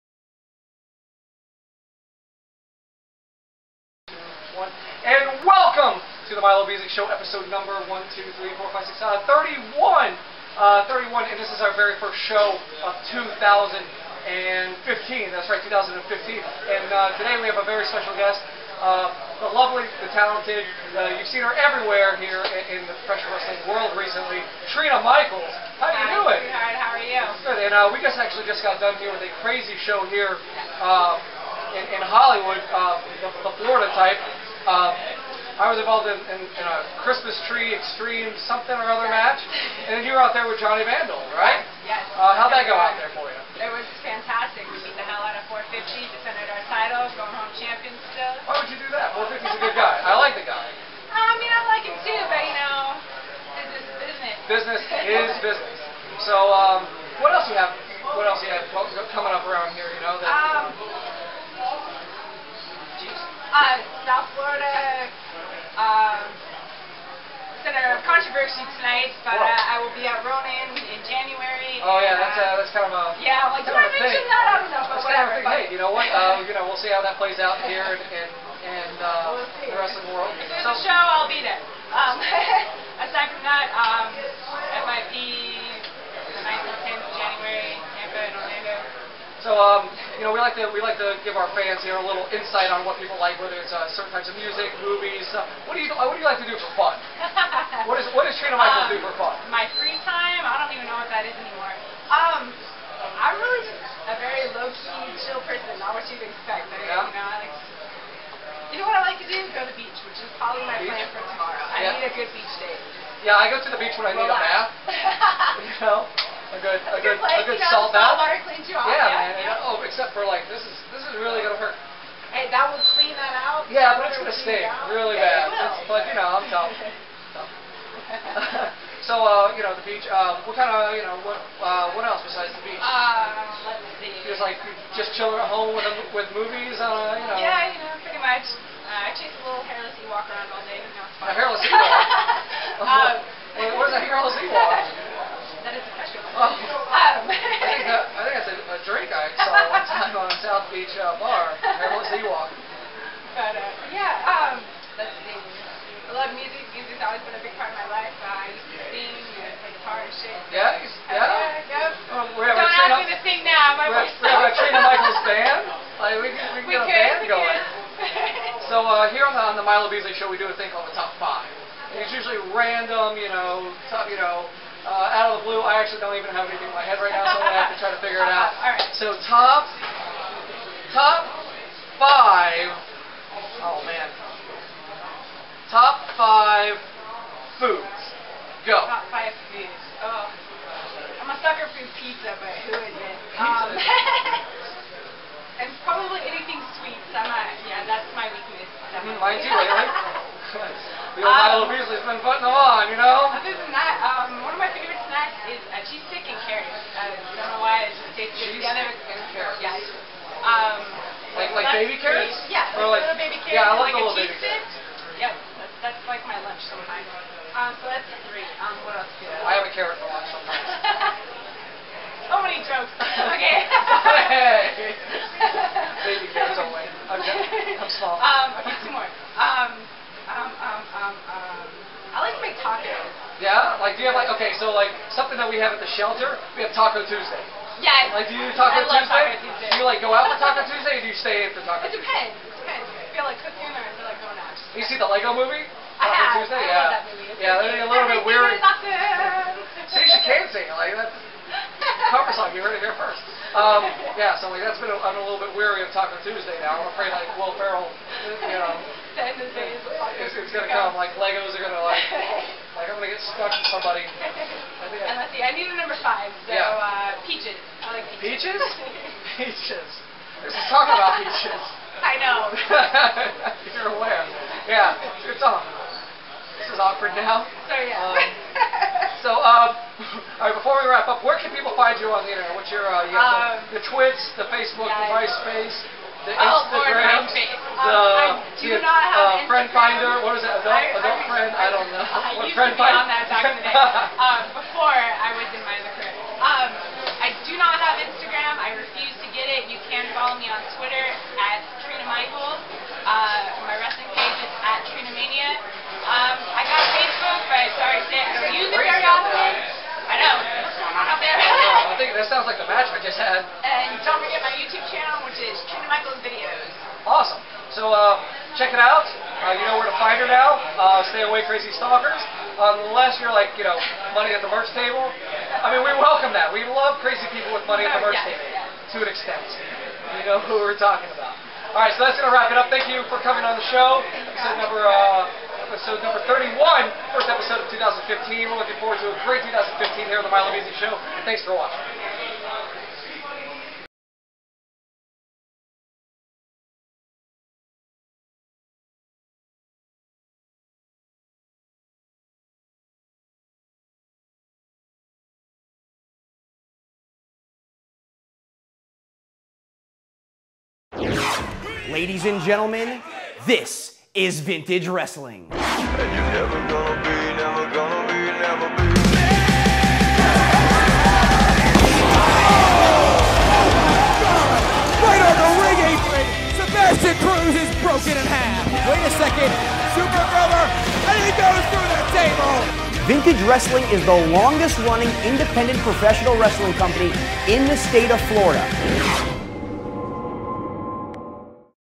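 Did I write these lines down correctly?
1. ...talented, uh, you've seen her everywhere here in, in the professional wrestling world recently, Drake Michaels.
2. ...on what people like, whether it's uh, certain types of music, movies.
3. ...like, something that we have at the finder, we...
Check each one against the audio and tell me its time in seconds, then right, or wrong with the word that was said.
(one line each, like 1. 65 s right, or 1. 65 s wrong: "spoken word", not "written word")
1. 20 s wrong: "Trina", not "Drake"
2. 92 s right
3. 234 s wrong: "shelter", not "finder".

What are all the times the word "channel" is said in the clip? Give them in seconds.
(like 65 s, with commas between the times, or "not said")
314 s.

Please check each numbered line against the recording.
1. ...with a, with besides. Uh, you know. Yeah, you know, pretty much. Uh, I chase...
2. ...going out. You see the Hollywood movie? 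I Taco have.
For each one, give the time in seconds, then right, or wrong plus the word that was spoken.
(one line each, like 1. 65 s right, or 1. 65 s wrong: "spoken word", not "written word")
1. 135 s wrong: "movies", not "besides"
2. 244 s wrong: "Lego", not "Hollywood".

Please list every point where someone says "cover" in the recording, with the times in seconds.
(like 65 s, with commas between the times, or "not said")
252 s.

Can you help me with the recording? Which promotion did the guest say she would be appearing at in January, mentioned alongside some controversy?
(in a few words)
Ronin.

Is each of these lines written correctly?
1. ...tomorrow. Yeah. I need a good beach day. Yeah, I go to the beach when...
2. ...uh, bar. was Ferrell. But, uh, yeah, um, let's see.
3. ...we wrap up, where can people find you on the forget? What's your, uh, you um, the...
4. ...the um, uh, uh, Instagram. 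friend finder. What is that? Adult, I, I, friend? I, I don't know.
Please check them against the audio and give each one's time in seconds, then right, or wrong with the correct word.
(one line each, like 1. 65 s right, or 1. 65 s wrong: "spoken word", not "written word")
1. 111 s right
2. 150 s wrong: "Ewok", not "Ferrell"
3. 280 s wrong: "internet", not "forget"
4. 287 s right.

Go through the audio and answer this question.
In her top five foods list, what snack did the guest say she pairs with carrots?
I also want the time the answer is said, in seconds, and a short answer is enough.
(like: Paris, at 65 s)
A cheese stick, at 205 s.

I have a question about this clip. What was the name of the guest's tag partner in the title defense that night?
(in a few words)
Johnny Vandal.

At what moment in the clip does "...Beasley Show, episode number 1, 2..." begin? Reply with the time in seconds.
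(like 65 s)
6 s.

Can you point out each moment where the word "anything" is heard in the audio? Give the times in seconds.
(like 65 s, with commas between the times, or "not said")
176 s, 196 s.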